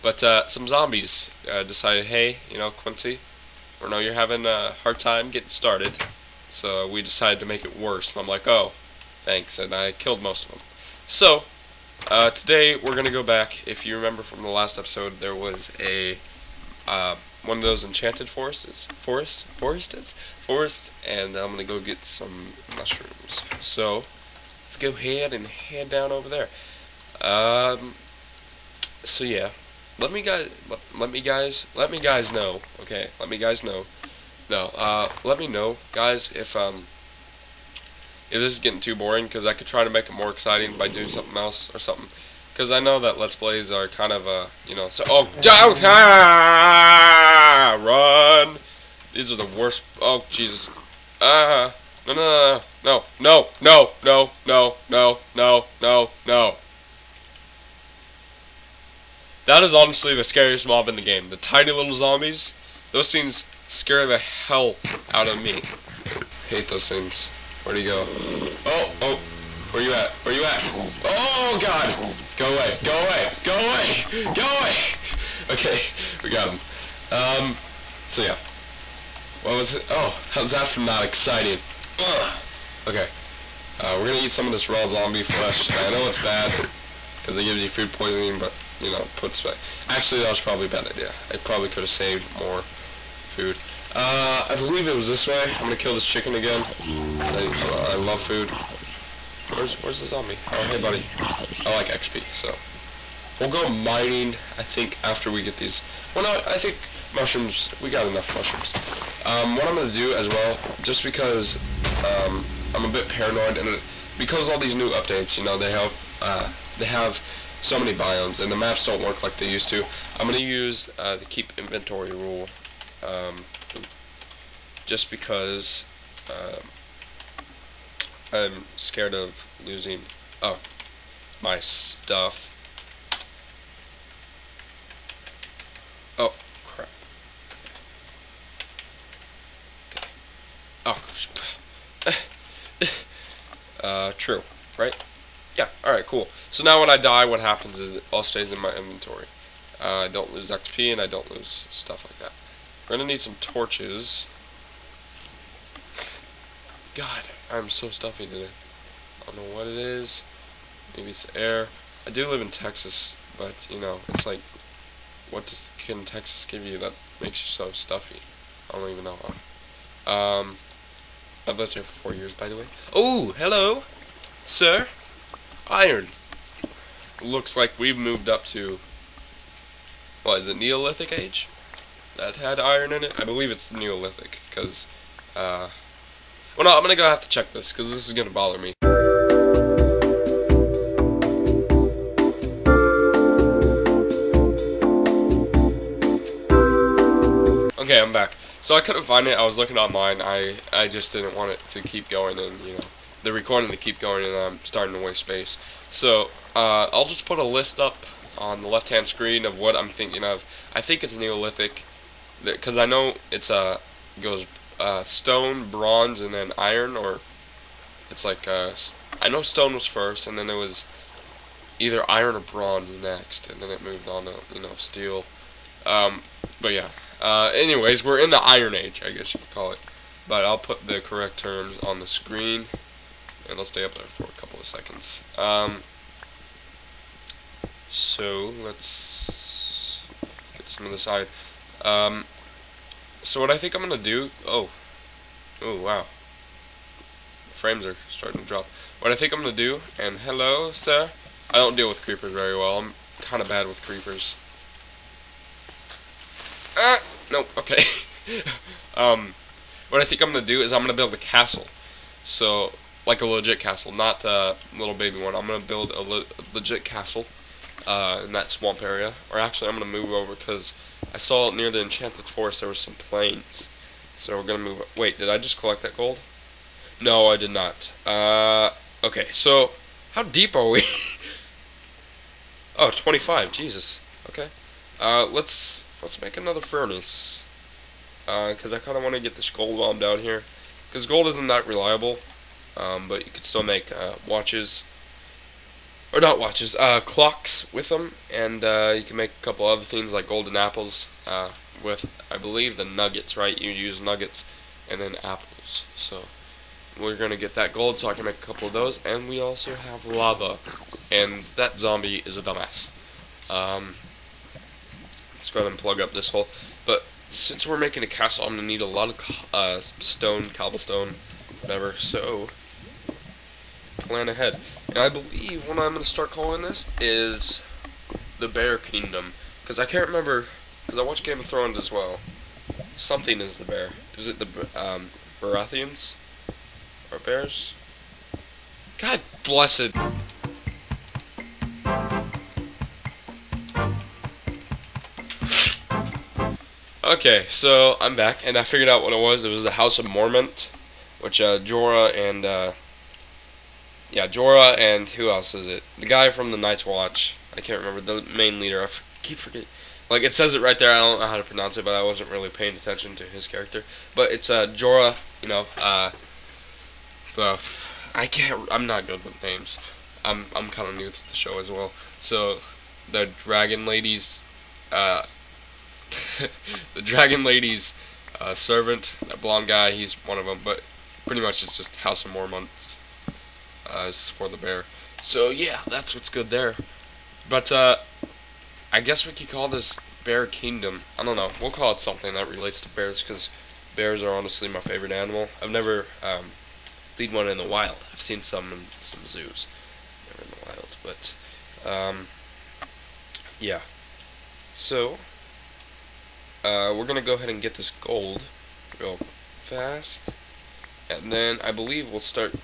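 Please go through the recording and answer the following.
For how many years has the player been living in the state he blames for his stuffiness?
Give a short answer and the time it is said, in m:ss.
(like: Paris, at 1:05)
4, at 2:51.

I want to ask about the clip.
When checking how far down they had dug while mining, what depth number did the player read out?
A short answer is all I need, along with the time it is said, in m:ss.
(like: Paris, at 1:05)
25, at 4:42.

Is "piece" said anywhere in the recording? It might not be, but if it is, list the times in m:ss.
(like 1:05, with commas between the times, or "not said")
not said.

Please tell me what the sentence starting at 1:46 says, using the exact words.
Well, no, I think mushrooms, we got enough mushrooms.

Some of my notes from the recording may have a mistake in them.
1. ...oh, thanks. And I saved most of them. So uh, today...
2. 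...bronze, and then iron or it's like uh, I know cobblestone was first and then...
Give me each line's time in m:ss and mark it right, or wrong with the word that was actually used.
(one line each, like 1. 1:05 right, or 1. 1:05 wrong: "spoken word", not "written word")
1. 0:08 wrong: "killed", not "saved"
2. 3:35 wrong: "stone", not "cobblestone".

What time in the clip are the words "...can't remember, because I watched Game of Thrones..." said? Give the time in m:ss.
5:29.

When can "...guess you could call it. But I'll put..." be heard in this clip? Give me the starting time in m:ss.
3:49.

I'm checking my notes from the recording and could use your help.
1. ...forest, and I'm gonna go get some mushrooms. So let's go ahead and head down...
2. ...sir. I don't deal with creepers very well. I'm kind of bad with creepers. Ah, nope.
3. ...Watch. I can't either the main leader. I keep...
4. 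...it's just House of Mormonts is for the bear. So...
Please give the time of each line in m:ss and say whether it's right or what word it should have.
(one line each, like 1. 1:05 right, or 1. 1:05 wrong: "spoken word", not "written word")
1. 0:20 right
2. 4:10 right
3. 5:56 wrong: "remember", not "either"
4. 6:21 right.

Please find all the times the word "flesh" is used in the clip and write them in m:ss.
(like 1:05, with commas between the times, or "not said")
1:25.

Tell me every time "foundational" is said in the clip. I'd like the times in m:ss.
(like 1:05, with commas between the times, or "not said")
not said.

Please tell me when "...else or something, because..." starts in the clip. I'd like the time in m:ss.
0:41.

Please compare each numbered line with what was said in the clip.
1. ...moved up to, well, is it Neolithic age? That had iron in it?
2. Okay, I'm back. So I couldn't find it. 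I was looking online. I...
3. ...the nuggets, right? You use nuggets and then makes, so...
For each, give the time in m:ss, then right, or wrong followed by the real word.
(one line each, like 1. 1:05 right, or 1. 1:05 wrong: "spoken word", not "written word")
1. 2:57 right
2. 3:17 right
3. 5:02 wrong: "apples", not "makes".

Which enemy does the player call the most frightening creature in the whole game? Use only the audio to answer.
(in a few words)
Tiny little zombies.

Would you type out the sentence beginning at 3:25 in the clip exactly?
So uh, I'll just put a list up on the left hand screen of what I'm thinking of.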